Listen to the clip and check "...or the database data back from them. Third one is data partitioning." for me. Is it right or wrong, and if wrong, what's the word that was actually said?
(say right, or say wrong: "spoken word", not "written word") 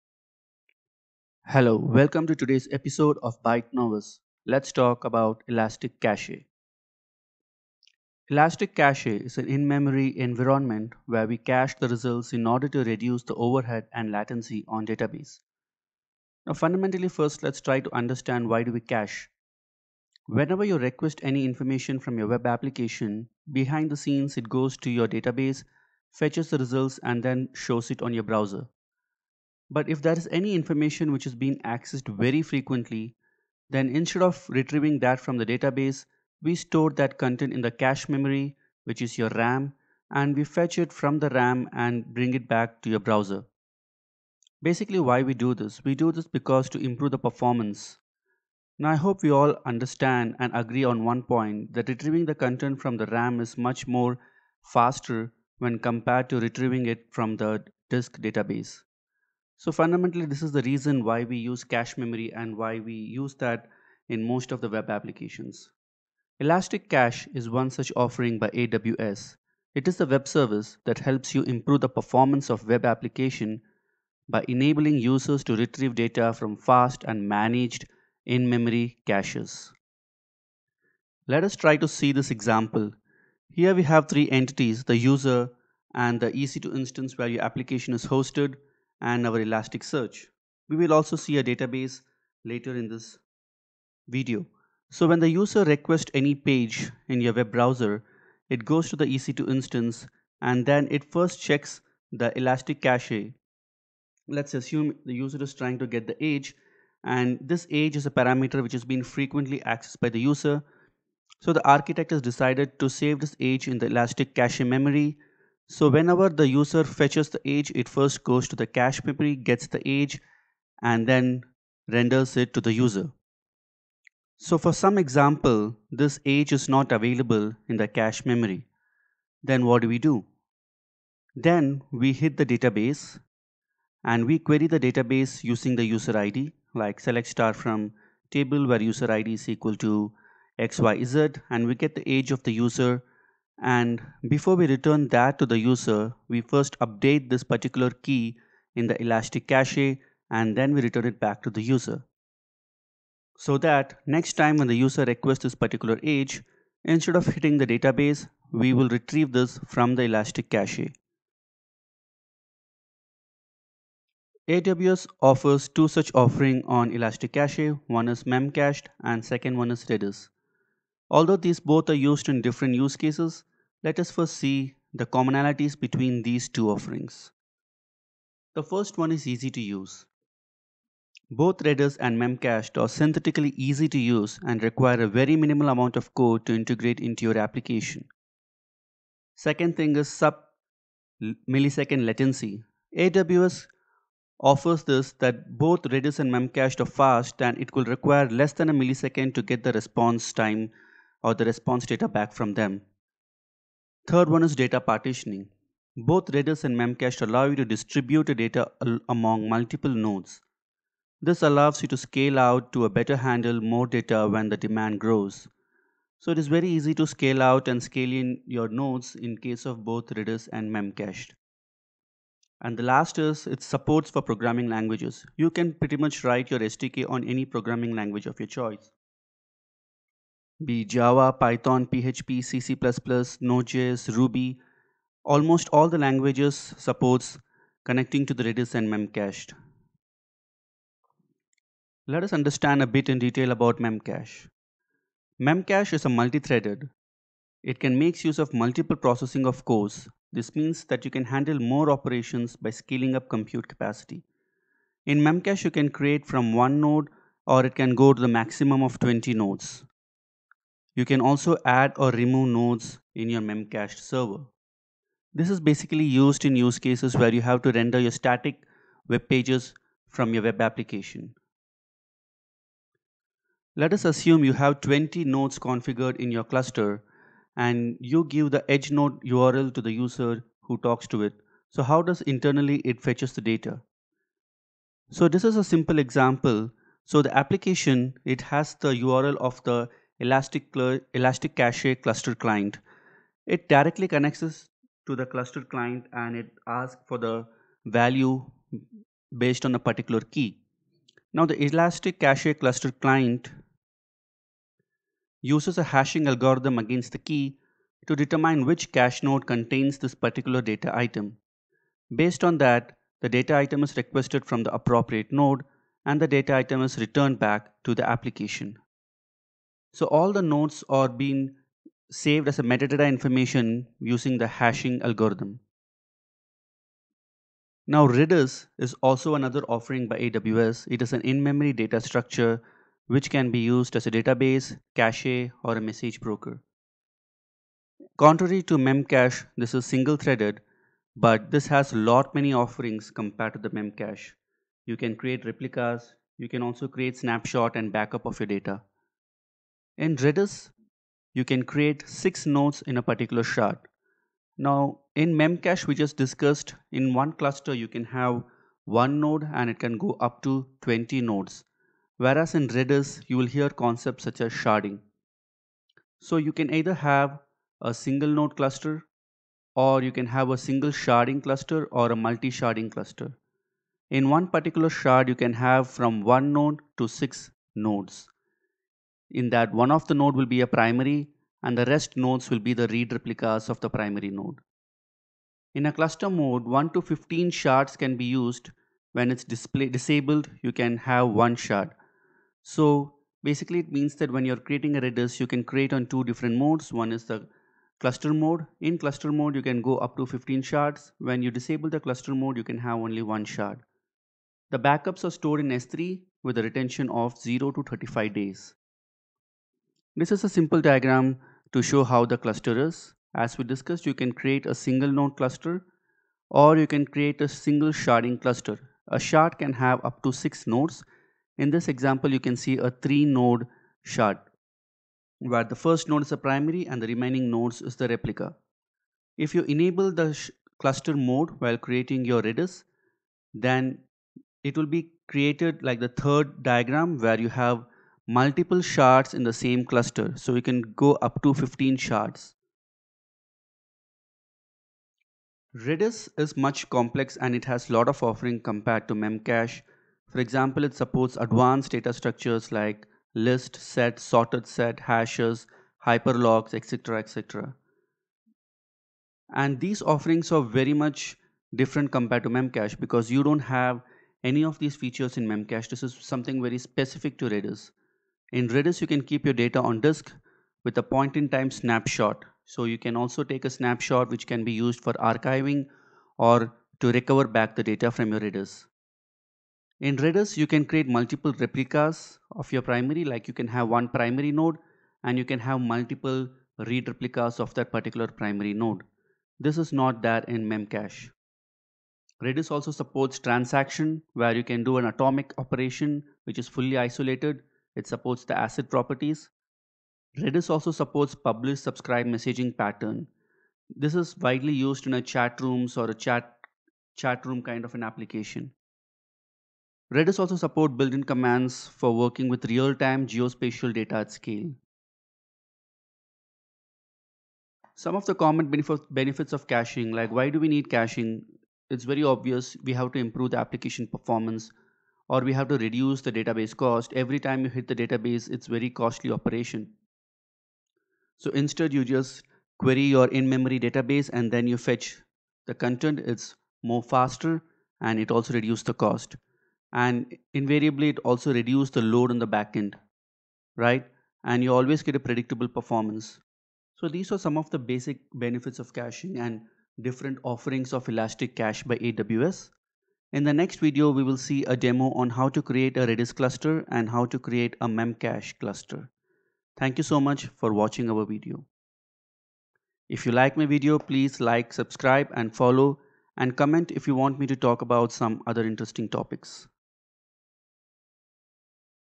wrong: "response", not "database".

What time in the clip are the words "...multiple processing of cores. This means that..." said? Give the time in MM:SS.
04:08.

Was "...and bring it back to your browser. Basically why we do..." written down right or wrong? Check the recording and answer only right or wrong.
right.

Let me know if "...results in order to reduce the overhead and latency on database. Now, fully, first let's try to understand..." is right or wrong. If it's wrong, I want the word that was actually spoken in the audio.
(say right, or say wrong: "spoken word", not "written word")
wrong: "fundamentally", not "fully".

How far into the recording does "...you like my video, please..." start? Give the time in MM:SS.
09:23.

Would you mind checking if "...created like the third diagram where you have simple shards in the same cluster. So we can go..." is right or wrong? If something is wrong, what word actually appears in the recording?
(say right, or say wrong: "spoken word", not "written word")
wrong: "multiple", not "simple".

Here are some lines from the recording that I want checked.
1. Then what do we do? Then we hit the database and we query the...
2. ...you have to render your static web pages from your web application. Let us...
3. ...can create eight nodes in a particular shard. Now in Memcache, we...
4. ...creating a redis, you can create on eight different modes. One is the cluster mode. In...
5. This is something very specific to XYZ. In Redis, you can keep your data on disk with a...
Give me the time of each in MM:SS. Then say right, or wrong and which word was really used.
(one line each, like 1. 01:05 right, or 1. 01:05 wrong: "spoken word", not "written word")
1. 02:09 right
2. 04:27 right
3. 05:51 wrong: "six", not "eight"
4. 06:34 wrong: "two", not "eight"
5. 07:45 wrong: "Redis", not "XYZ".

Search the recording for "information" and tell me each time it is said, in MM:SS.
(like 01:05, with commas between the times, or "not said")
00:21, 00:30, 05:23.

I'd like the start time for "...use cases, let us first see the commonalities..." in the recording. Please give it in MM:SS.
02:52.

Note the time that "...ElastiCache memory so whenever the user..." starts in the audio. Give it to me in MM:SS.
01:53.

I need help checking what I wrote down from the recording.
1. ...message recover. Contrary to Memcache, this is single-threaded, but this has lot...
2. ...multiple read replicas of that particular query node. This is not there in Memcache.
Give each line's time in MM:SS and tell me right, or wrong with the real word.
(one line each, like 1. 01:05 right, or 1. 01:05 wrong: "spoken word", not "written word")
1. 05:35 wrong: "broker", not "recover"
2. 08:05 wrong: "primary", not "query".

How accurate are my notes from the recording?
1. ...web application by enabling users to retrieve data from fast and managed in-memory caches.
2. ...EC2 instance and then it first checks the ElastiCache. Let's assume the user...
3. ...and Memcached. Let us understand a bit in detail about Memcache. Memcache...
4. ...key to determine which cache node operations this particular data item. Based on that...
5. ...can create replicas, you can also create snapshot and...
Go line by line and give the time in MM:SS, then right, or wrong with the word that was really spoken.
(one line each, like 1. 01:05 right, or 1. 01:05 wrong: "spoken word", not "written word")
1. 01:12 right
2. 01:39 right
3. 03:58 right
4. 05:07 wrong: "contains", not "operations"
5. 05:44 right.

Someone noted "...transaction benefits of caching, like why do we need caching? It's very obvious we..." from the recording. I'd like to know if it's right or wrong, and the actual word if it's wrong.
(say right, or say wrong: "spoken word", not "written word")
wrong: "common", not "transaction".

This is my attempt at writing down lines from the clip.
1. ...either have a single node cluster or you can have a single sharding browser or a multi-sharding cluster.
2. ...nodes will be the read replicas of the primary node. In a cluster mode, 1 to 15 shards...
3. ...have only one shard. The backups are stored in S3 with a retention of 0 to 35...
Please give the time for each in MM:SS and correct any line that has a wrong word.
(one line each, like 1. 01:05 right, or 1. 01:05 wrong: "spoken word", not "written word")
1. 06:06 wrong: "cluster", not "browser"
2. 06:22 right
3. 06:42 right.